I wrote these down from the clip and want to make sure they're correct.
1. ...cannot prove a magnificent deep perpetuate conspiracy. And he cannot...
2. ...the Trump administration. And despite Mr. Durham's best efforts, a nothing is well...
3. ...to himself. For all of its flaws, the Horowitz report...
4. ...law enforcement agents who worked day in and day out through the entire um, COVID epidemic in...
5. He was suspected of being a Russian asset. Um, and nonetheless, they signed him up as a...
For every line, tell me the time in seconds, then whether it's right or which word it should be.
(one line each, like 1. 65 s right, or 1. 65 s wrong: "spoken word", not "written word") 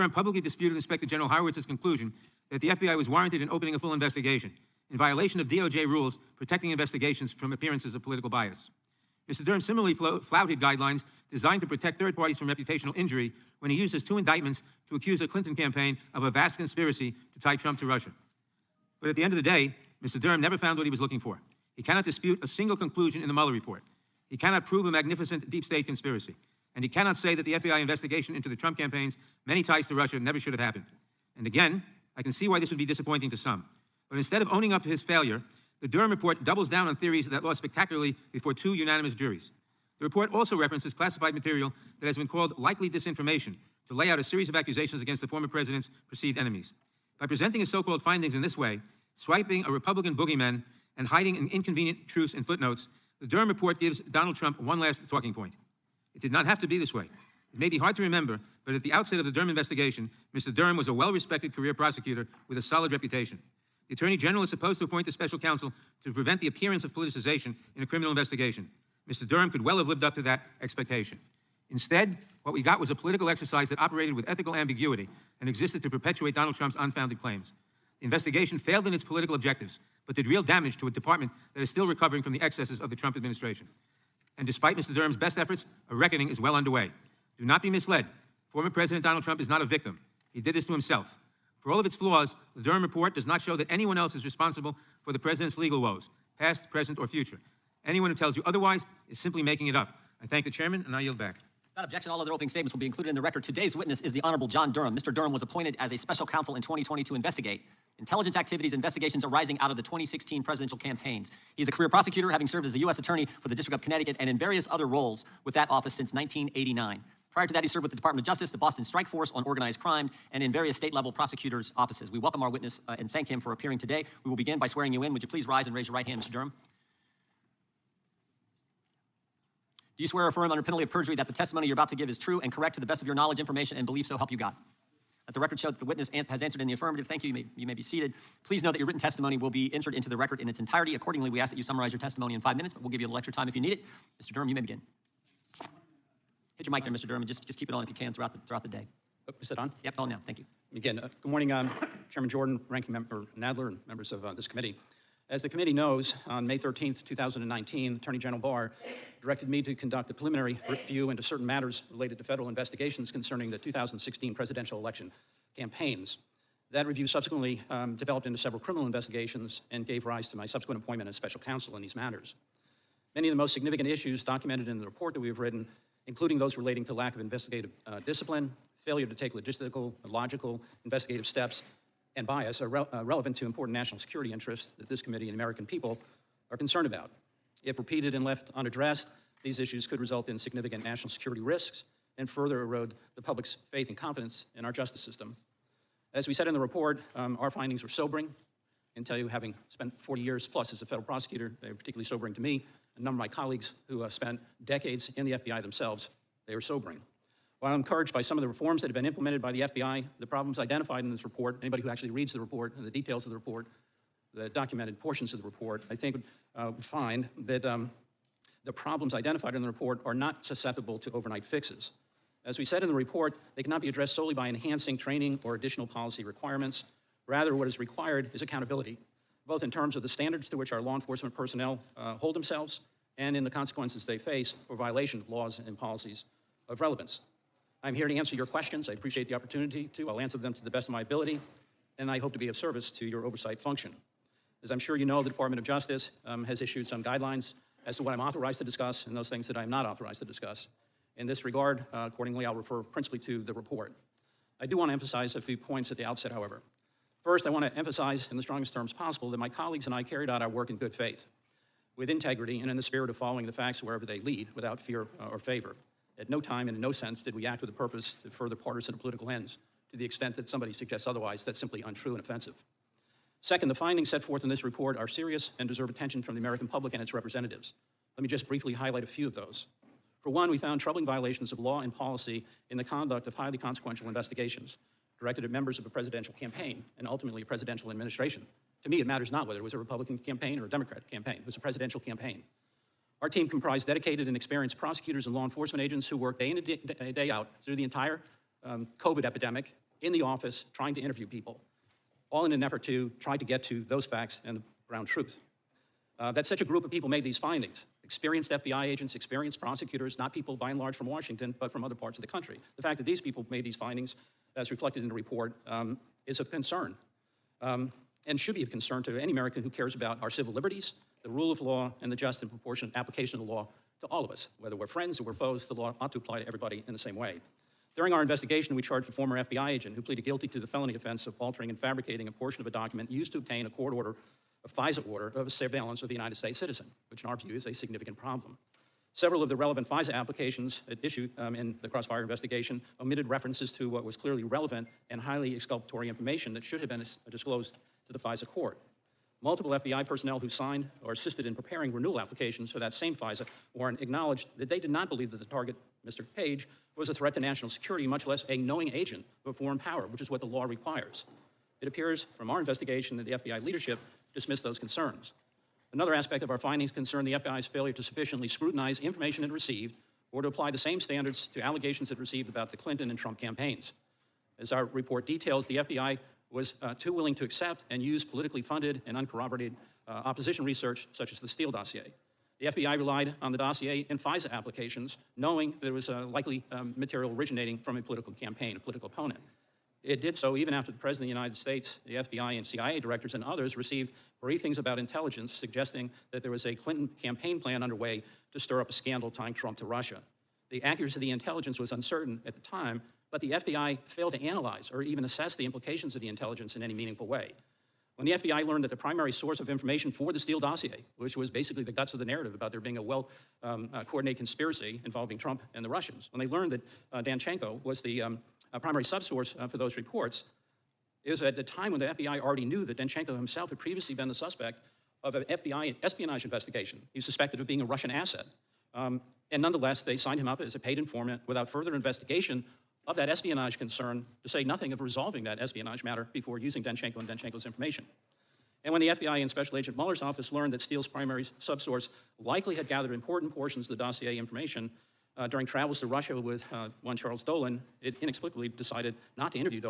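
1. 24 s wrong: "state", not "perpetuate"
2. 82 s wrong: "reckoning", not "nothing"
3. 90 s wrong: "Durham", not "Horowitz"
4. 295 s right
5. 427 s right.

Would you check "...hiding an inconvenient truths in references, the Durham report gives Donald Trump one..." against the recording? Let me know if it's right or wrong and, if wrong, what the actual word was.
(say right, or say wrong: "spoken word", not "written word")
wrong: "footnotes", not "references".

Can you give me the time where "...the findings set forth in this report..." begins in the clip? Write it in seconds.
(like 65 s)
273 s.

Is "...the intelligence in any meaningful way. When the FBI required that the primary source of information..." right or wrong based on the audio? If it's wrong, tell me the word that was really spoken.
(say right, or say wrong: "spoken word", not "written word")
wrong: "learned", not "required".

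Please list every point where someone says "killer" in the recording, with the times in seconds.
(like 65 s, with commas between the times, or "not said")
not said.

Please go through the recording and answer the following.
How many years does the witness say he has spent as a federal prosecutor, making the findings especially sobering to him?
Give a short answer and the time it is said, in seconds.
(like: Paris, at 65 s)
40, at 200 s.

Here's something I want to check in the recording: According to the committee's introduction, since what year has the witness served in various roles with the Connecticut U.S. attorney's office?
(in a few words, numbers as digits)
1989.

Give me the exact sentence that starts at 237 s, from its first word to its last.
I'm here to answer your questions.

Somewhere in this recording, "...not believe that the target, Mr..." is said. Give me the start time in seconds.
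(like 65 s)
354 s.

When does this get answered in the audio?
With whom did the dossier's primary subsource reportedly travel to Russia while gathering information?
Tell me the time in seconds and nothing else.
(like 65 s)
447 s.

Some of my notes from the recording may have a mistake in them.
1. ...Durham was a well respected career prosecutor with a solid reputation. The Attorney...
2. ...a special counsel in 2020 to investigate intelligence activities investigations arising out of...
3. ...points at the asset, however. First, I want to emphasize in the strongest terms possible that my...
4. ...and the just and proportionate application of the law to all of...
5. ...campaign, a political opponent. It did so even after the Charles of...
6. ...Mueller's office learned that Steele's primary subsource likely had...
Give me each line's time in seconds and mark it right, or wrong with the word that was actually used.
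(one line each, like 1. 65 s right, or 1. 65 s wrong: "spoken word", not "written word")
1. 60 s right
2. 105 s right
3. 255 s wrong: "outset", not "asset"
4. 322 s right
5. 388 s wrong: "President", not "Charles"
6. 439 s right.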